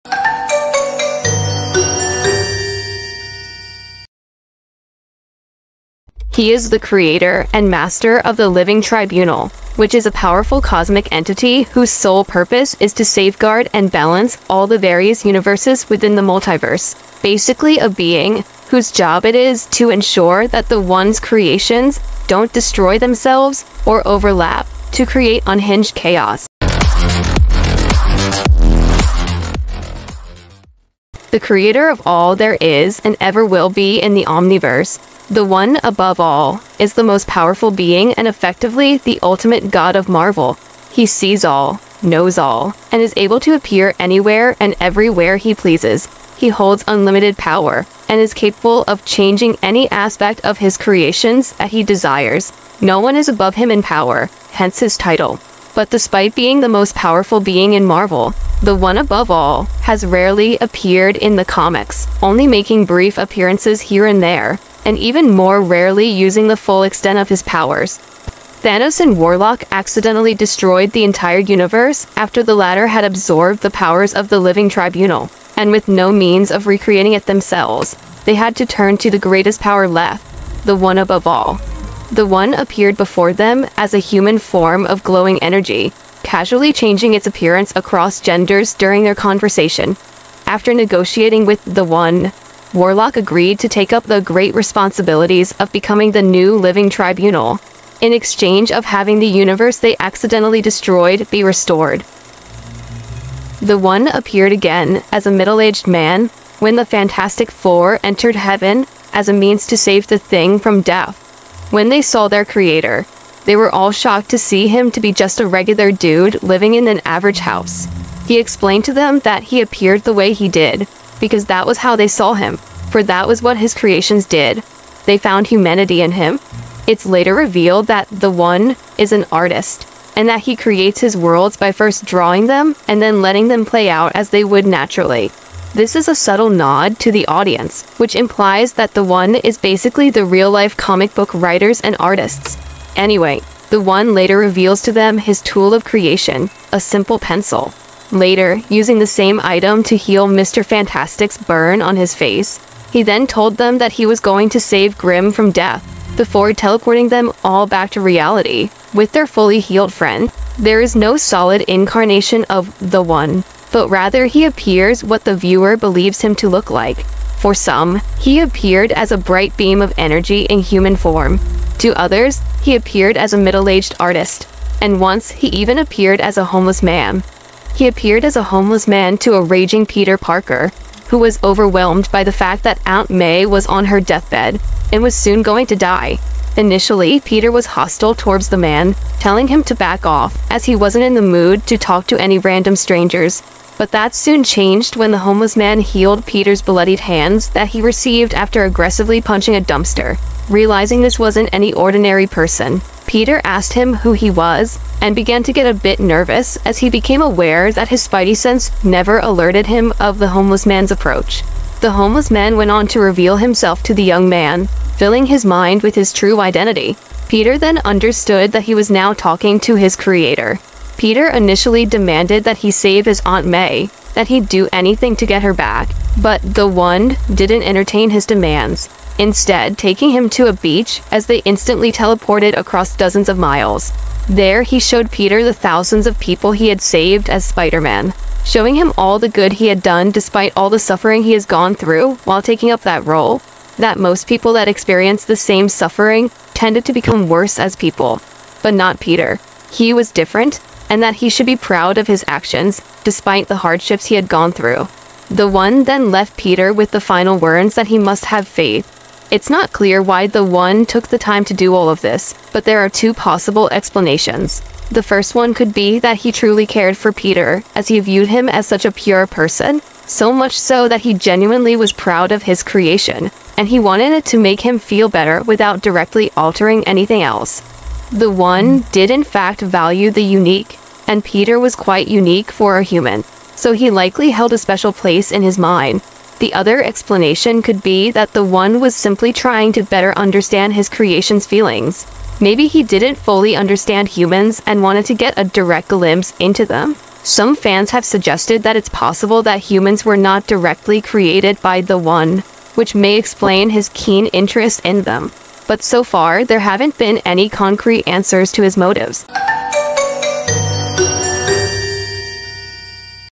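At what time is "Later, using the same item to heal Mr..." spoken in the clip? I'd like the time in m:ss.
2:28.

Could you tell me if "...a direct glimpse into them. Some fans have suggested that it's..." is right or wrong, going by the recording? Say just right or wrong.
right.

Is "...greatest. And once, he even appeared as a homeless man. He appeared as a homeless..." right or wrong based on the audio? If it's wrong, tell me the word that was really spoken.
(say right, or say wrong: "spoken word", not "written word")
wrong: "artist", not "greatest".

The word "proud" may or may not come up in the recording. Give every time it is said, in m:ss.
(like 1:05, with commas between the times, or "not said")
4:11, 4:31.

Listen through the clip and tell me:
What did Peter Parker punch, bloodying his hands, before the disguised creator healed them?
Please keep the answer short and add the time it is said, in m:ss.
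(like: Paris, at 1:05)
A dumpster, at 3:19.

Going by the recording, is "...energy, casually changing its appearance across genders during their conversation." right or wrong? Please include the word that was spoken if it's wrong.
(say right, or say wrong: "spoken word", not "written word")
right.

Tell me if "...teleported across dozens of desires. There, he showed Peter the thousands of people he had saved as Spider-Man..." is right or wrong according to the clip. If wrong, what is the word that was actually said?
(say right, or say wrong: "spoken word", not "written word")
wrong: "miles", not "desires".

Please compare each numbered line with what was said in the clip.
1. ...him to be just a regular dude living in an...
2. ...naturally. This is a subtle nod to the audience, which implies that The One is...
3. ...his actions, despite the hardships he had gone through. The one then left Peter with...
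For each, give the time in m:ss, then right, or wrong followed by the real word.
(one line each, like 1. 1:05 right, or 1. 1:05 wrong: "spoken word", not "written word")
1. 1:54 right
2. 2:14 right
3. 4:12 right.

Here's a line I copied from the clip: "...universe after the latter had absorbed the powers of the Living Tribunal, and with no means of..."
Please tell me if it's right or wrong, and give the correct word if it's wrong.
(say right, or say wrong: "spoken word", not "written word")
right.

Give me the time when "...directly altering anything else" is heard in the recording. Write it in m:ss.
4:35.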